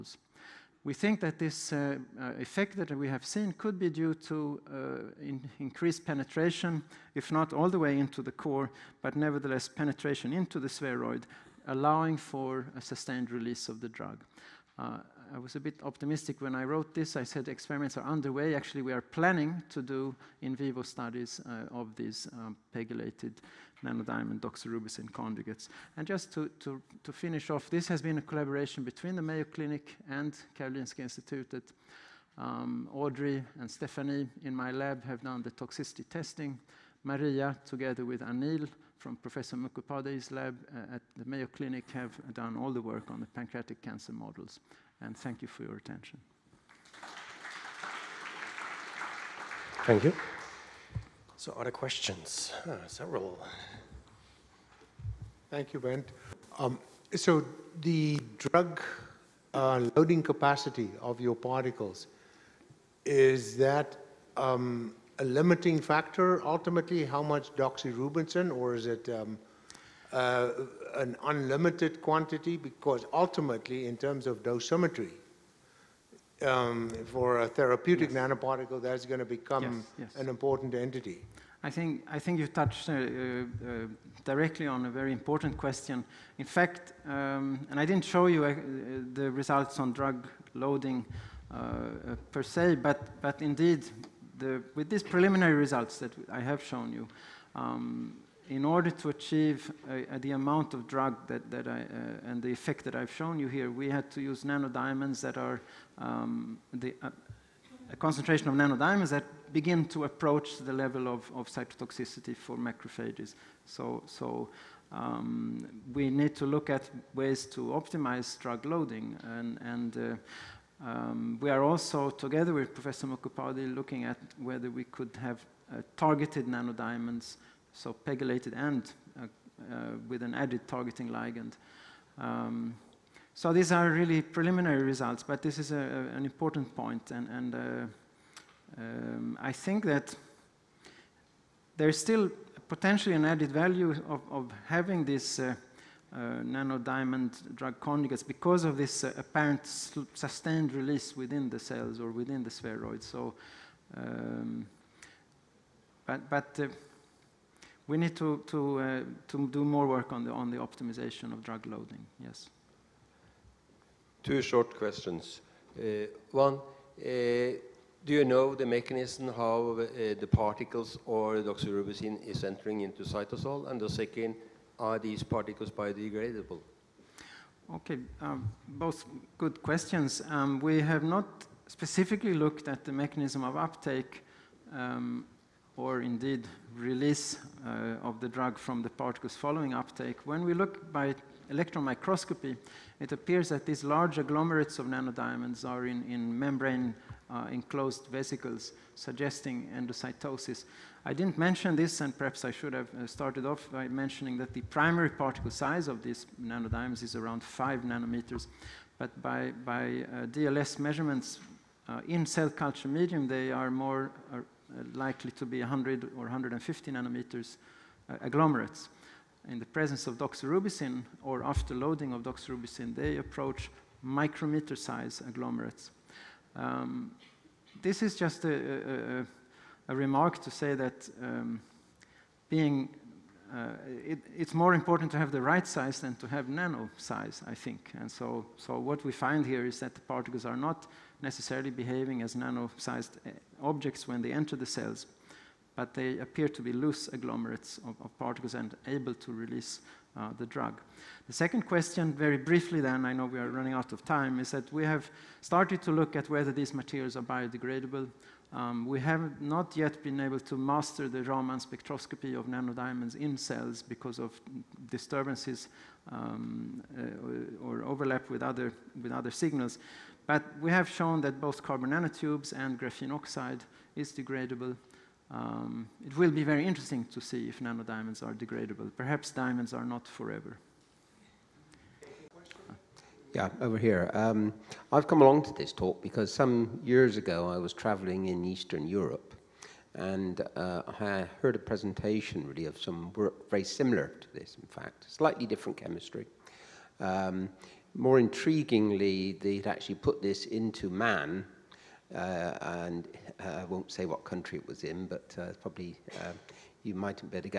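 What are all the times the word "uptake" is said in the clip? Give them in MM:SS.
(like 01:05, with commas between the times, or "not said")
03:03, 03:09.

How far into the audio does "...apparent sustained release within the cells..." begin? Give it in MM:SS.
02:29.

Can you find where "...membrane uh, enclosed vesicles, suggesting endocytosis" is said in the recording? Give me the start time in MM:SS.
03:16.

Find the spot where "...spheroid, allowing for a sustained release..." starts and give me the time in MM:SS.
00:10.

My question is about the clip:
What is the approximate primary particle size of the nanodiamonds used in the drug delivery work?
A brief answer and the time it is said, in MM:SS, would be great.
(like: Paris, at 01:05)
5 nanometers, at 03:27.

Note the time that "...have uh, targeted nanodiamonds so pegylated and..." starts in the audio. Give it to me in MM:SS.
02:05.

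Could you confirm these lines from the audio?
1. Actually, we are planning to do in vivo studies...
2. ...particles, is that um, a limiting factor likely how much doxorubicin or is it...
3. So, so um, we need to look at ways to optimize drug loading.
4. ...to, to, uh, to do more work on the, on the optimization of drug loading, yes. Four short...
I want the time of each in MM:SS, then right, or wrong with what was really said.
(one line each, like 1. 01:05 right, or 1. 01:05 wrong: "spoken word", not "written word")
1. 00:18 right
2. 01:01 wrong: "ultimately", not "likely"
3. 01:53 right
4. 02:38 wrong: "Two", not "Four".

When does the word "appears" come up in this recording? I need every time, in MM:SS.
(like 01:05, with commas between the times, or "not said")
03:13, 04:06.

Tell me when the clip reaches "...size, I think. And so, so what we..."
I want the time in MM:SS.
03:56.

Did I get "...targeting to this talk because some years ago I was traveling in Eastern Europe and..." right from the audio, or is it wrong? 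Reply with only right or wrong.
wrong.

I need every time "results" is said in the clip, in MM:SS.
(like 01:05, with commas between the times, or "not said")
01:29, 01:35, 02:14.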